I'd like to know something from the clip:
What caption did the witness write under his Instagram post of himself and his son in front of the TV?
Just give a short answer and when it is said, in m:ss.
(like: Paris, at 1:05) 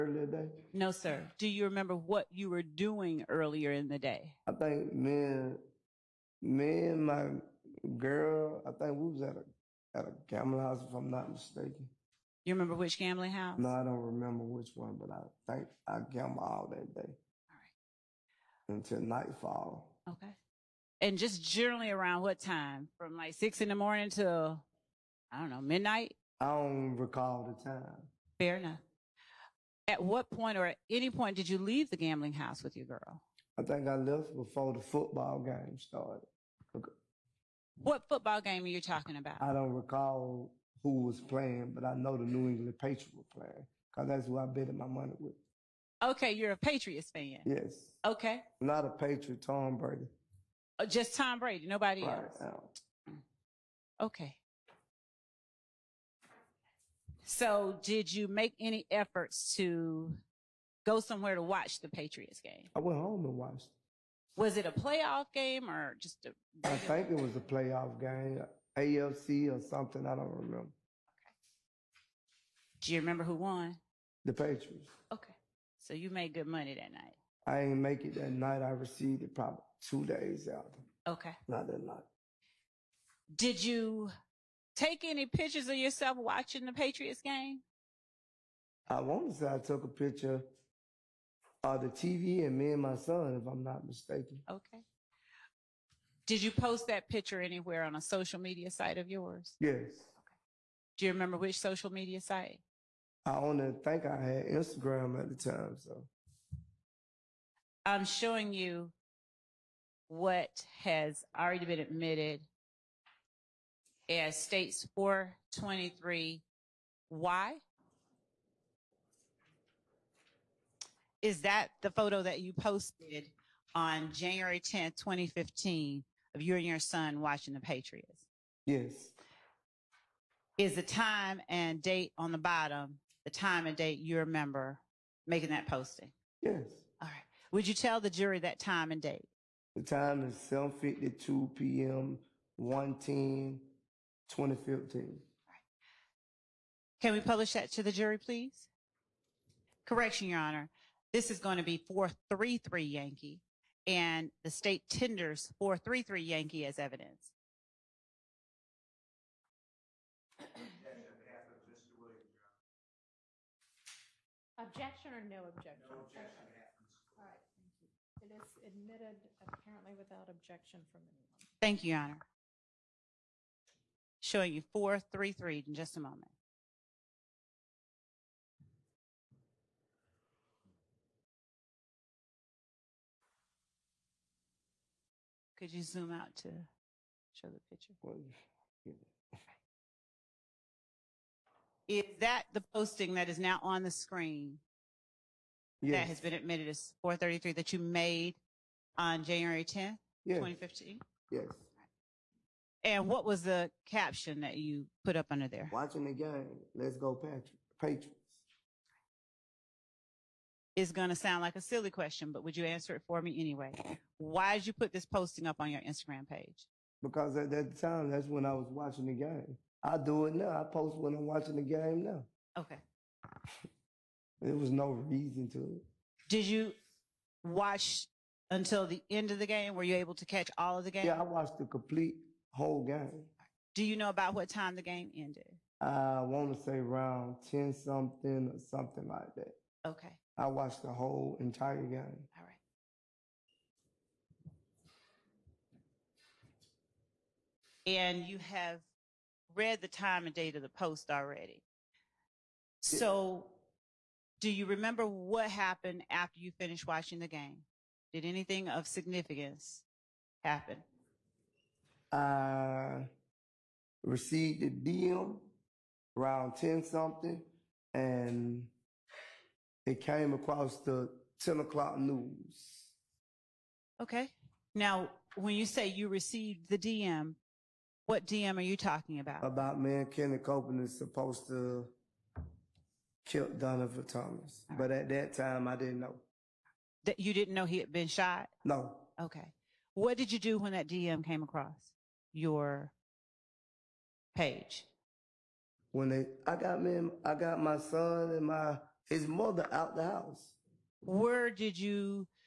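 Watching the game. Let's go Patriots., at 3:25.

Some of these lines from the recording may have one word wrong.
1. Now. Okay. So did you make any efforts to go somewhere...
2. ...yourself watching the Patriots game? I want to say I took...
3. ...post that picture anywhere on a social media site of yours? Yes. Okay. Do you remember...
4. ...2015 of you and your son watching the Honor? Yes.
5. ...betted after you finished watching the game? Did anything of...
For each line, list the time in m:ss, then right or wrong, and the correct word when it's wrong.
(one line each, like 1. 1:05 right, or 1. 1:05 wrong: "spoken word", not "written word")
1. 0:53 right
2. 1:25 right
3. 1:36 right
4. 2:04 wrong: "Patriots", not "Honor"
5. 4:15 wrong: "happened", not "betted".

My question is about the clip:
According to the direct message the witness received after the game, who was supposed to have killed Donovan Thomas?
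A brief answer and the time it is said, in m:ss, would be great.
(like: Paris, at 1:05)
Kenny Copeland, at 4:40.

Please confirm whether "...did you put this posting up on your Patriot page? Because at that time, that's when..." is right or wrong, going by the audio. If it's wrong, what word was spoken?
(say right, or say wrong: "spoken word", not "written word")
wrong: "Instagram", not "Patriot".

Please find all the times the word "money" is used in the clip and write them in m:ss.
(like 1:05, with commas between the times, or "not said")
0:44, 1:16.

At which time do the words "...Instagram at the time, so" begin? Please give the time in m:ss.
1:44.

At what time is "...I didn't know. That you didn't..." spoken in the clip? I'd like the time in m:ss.
4:45.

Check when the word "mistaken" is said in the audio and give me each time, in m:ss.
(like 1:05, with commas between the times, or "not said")
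0:11, 1:33.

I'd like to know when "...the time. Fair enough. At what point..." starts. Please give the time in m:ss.
0:27.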